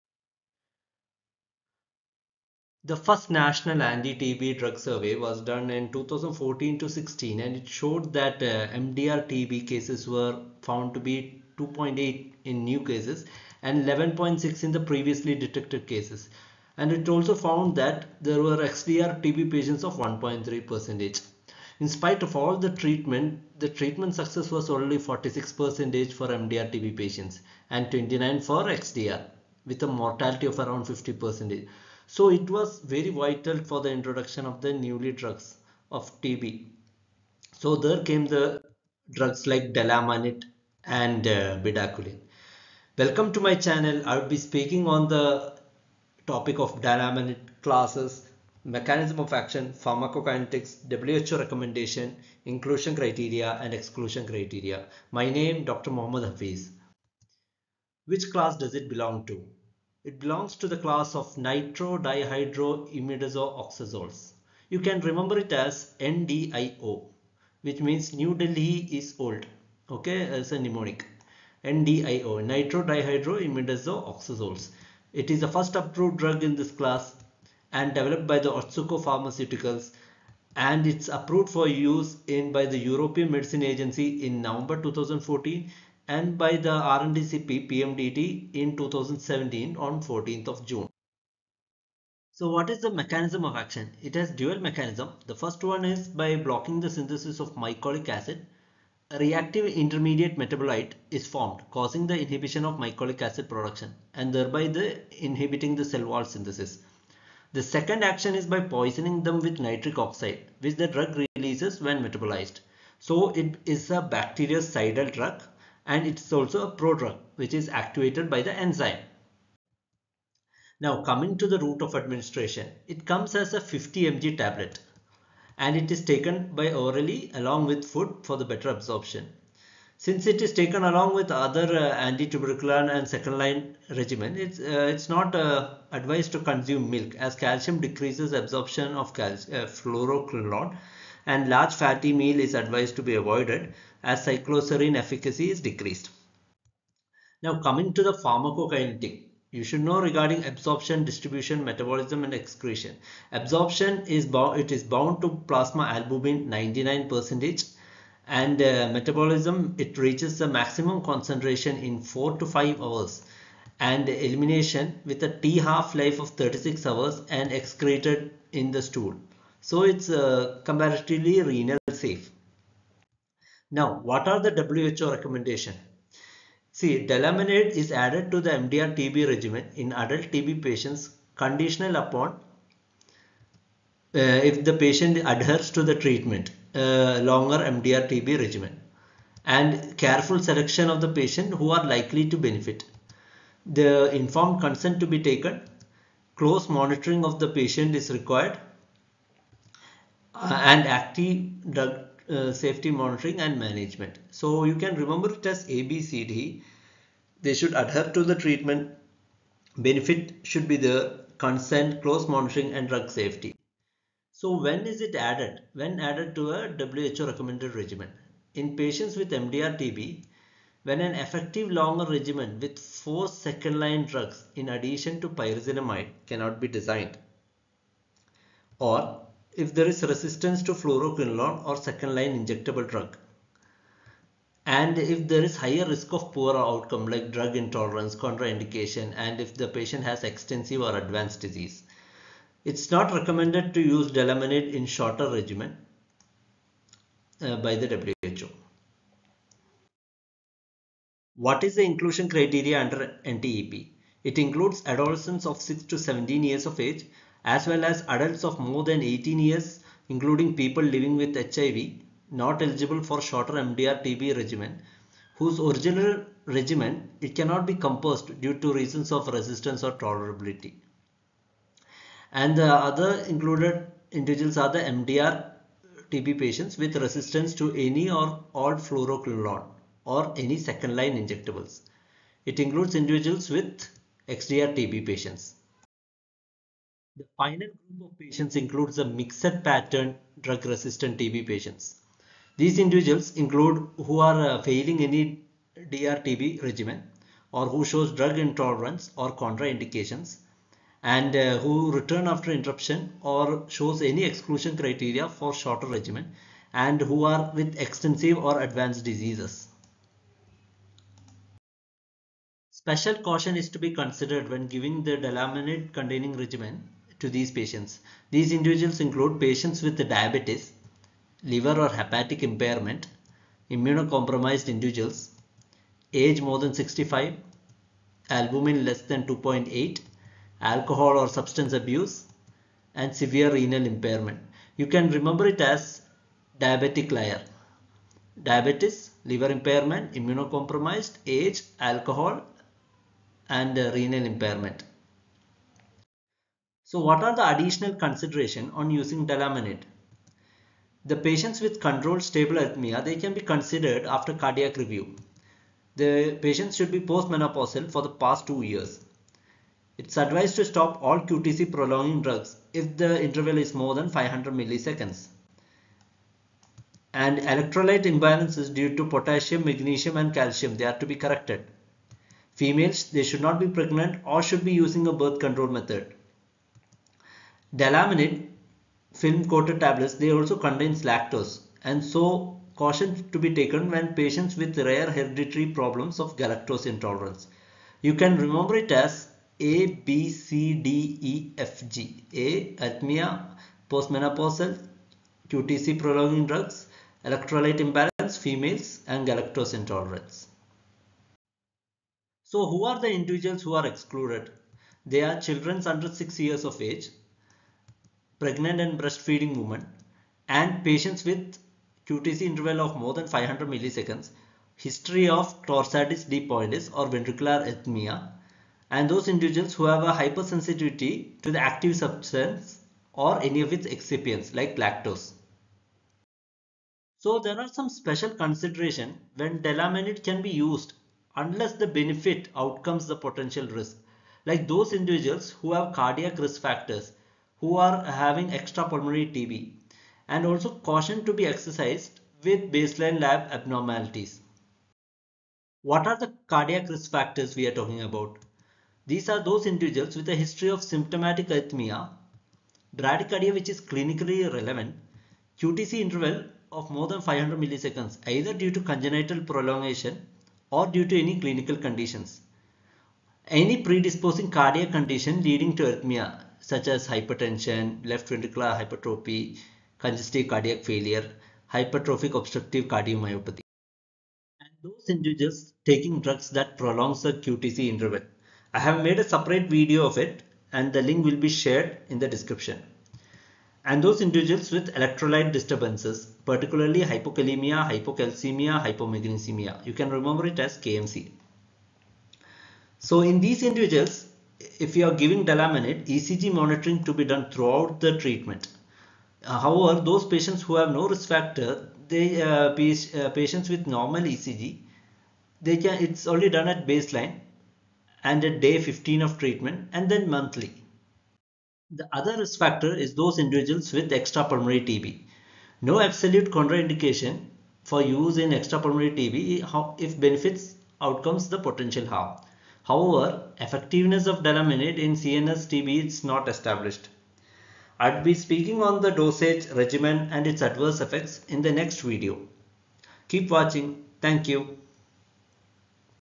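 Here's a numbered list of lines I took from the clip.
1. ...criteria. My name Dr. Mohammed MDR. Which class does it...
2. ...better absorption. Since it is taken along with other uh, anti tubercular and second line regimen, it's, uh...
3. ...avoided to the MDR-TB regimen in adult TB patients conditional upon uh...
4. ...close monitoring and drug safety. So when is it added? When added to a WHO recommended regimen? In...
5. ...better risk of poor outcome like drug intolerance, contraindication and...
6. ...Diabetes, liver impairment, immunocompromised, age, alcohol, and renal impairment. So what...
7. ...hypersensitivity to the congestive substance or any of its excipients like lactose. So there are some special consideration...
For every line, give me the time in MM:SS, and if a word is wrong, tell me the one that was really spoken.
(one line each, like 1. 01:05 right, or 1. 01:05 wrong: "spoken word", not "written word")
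1. 00:54 wrong: "Hafiz", not "MDR"
2. 02:08 right
3. 02:57 wrong: "added", not "avoided"
4. 03:32 right
5. 03:55 wrong: "higher", not "better"
6. 05:38 right
7. 07:00 wrong: "active", not "congestive".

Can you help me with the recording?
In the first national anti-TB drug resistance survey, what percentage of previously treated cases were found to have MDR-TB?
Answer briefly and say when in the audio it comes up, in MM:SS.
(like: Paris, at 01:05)
11.6, at 00:13.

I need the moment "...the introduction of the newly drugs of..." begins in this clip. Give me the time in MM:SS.
00:33.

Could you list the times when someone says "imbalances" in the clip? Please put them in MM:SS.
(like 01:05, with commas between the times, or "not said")
06:08, 06:37.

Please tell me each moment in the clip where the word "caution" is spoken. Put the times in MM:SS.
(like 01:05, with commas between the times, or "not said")
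05:13, 06:22, 07:20.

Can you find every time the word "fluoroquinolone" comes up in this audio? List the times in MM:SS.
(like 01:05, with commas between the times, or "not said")
02:19, 03:50, 04:38.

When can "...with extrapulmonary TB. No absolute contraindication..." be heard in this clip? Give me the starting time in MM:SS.
08:33.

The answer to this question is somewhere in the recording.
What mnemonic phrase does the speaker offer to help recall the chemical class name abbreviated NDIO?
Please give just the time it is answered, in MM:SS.
01:08.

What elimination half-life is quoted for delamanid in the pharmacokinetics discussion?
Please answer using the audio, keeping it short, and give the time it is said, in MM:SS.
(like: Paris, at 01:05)
36 hours, at 02:46.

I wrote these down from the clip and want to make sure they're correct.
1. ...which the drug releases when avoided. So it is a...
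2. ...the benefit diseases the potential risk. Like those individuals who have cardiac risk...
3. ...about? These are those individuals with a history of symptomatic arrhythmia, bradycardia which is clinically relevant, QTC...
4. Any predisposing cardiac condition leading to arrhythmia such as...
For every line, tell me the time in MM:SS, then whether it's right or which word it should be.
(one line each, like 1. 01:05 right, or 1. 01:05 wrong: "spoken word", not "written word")
1. 01:50 wrong: "metabolized", not "avoided"
2. 07:11 wrong: "outcomes", not "diseases"
3. 07:28 right
4. 07:43 right.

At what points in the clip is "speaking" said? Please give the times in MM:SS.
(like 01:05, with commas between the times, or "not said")
00:44, 08:48.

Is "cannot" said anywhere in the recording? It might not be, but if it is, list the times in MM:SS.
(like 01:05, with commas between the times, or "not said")
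03:46, 04:27.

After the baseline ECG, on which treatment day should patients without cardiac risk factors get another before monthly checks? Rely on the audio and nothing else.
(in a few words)
day 15.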